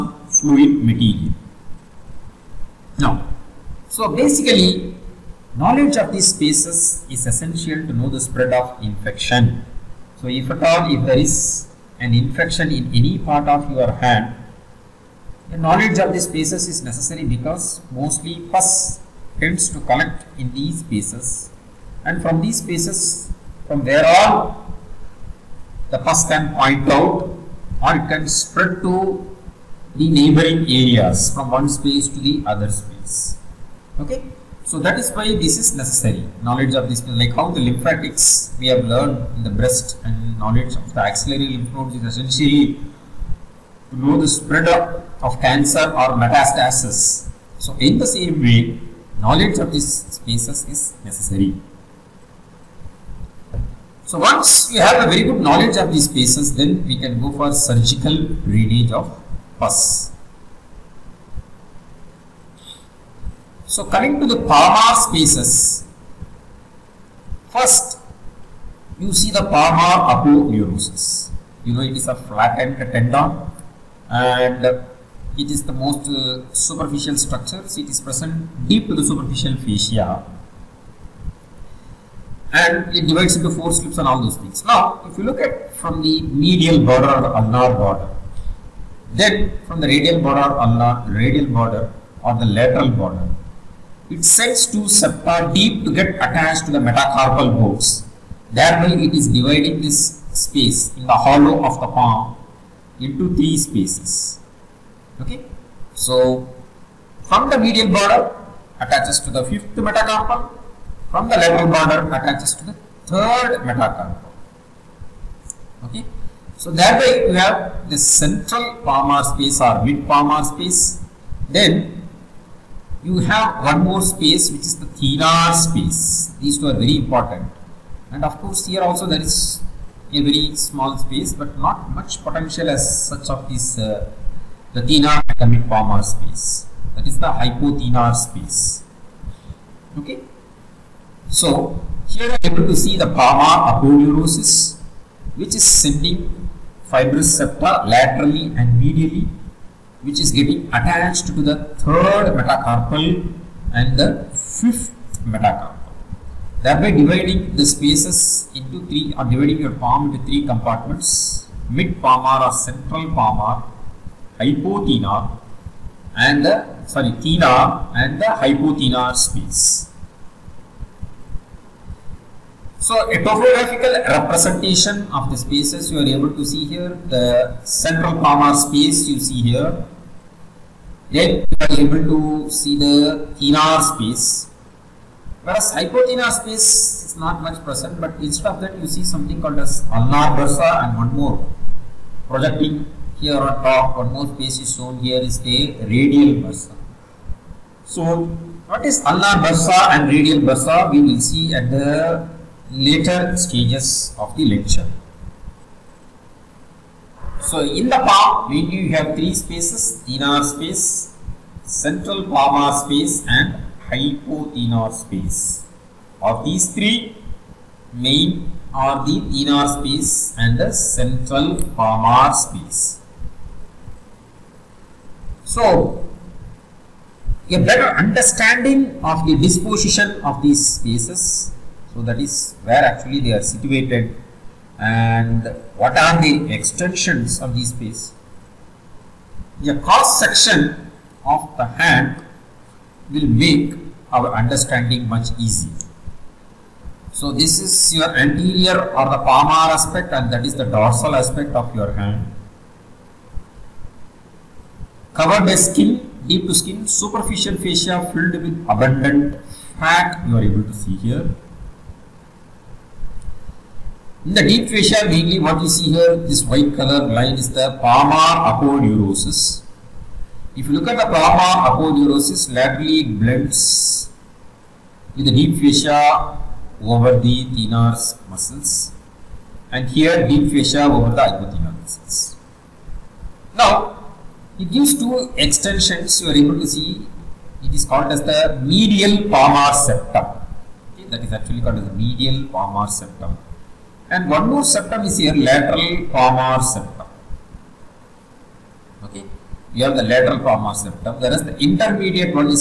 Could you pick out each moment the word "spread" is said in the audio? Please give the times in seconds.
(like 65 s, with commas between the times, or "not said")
8 s, 28 s, 44 s.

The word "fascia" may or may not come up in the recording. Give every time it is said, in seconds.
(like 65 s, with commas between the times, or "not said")
79 s, 257 s, 264 s, 275 s, 280 s.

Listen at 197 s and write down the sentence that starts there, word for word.
So what is ulnar bursa and radial bursa we will see at the later stages of the lecture.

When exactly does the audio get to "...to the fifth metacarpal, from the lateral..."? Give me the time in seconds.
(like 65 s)
109 s.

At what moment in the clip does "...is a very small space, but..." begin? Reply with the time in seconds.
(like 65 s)
129 s.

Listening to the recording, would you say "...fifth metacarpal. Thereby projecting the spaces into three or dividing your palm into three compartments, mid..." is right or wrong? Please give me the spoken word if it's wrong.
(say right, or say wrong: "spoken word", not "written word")
wrong: "dividing", not "projecting".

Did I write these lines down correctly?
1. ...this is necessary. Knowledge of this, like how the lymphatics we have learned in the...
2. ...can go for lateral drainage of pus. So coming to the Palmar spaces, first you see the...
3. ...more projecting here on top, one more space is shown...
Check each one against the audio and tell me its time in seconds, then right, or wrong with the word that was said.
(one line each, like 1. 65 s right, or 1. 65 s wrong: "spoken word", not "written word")
1. 35 s right
2. 56 s wrong: "surgical", not "lateral"
3. 191 s right.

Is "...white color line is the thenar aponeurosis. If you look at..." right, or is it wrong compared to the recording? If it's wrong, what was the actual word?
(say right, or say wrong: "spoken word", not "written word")
wrong: "palmar", not "thenar".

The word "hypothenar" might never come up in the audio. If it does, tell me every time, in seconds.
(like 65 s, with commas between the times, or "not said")
137 s, 164 s, 168 s, 185 s, 213 s, 281 s.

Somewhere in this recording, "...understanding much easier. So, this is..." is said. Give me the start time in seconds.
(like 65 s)
244 s.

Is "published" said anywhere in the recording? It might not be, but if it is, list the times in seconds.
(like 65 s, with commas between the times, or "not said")
not said.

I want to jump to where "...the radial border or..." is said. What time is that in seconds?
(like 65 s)
89 s.